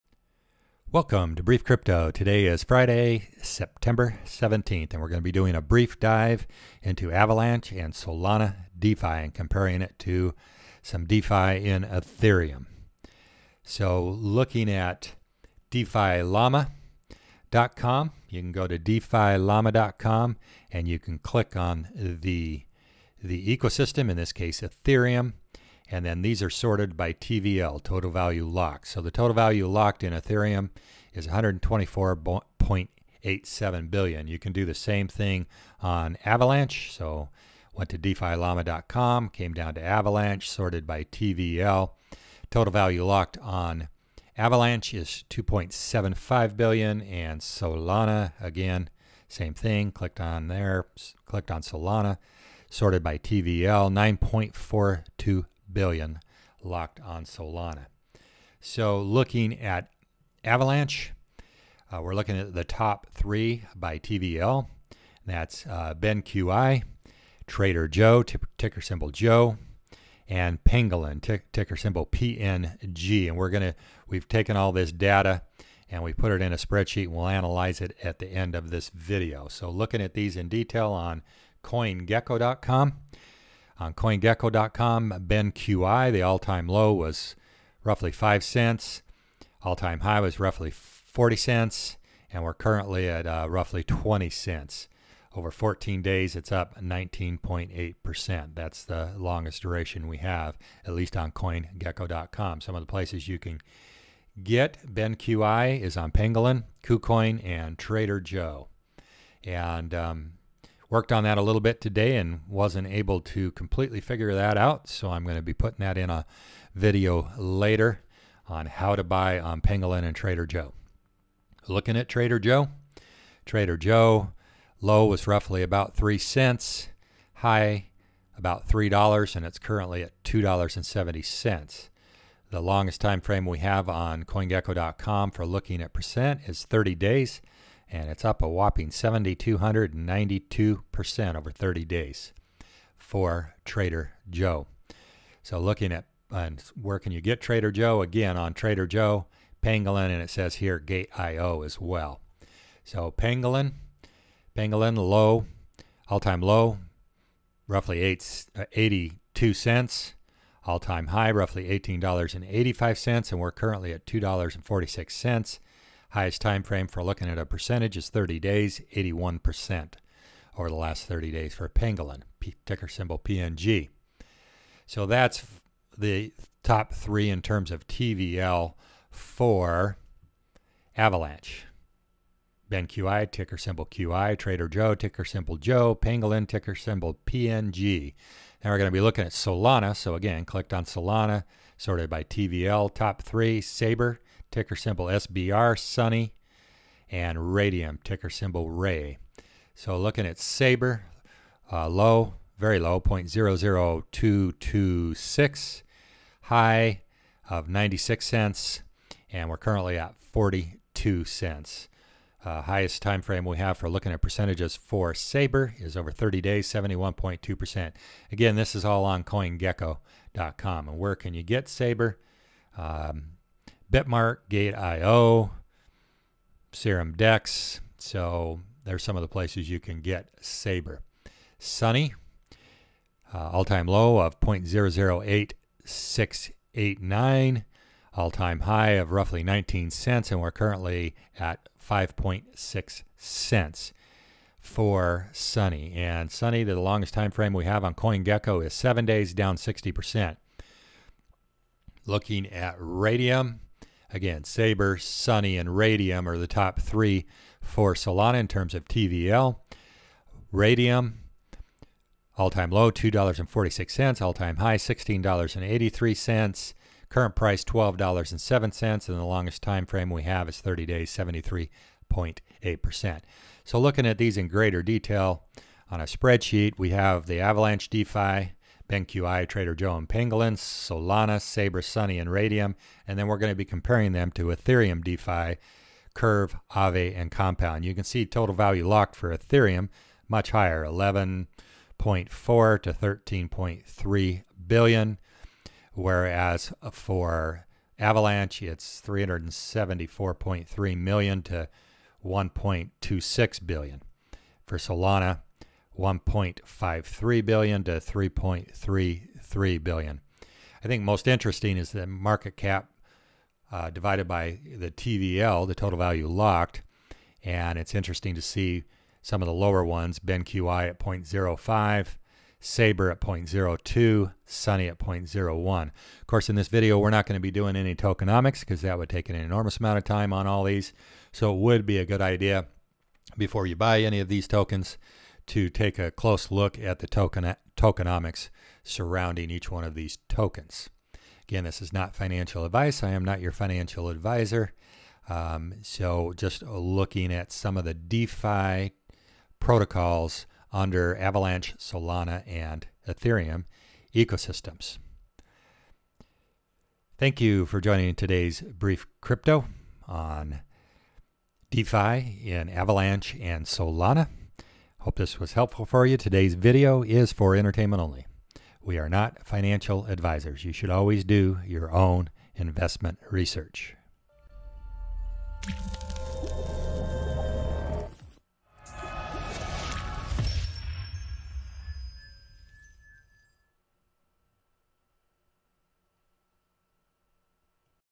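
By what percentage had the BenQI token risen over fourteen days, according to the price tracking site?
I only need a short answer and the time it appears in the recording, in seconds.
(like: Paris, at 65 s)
19.8%, at 96 s.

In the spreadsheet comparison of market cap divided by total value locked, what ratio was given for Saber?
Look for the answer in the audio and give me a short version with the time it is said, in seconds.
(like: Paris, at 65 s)
0.02, at 323 s.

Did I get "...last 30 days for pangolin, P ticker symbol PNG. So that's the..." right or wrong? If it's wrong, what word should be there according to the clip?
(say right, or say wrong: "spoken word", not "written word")
right.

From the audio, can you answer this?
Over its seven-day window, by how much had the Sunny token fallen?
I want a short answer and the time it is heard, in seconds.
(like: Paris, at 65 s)
60%, at 249 s.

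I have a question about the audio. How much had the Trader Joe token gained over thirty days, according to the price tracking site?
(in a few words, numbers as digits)
7,292%.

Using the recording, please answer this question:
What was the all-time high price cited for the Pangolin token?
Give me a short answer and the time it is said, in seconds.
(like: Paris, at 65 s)
$18.85, at 161 s.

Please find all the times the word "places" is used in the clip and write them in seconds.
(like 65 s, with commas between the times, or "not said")
102 s, 229 s.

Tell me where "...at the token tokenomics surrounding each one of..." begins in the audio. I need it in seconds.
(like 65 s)
336 s.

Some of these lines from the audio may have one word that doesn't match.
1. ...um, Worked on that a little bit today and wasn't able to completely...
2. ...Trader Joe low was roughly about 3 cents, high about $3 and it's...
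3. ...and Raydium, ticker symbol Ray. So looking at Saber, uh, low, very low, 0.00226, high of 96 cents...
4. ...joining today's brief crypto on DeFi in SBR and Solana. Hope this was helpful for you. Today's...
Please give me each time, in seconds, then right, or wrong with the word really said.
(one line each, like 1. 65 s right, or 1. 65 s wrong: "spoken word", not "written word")
1. 109 s right
2. 123 s right
3. 197 s right
4. 357 s wrong: "Avalanche", not "SBR".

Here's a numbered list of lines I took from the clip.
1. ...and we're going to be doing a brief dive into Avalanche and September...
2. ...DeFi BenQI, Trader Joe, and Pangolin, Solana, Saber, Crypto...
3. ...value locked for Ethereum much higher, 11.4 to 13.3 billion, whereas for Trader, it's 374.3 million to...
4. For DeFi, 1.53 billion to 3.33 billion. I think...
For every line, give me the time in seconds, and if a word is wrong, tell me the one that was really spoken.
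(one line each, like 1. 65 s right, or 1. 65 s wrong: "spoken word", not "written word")
1. 4 s wrong: "Solana", not "September"
2. 277 s wrong: "Sunny", not "Crypto"
3. 288 s wrong: "Avalanche", not "Trader"
4. 304 s wrong: "Solana", not "DeFi".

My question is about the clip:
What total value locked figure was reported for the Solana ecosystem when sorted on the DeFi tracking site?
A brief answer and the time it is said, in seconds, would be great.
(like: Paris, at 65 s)
9.42 billion, at 53 s.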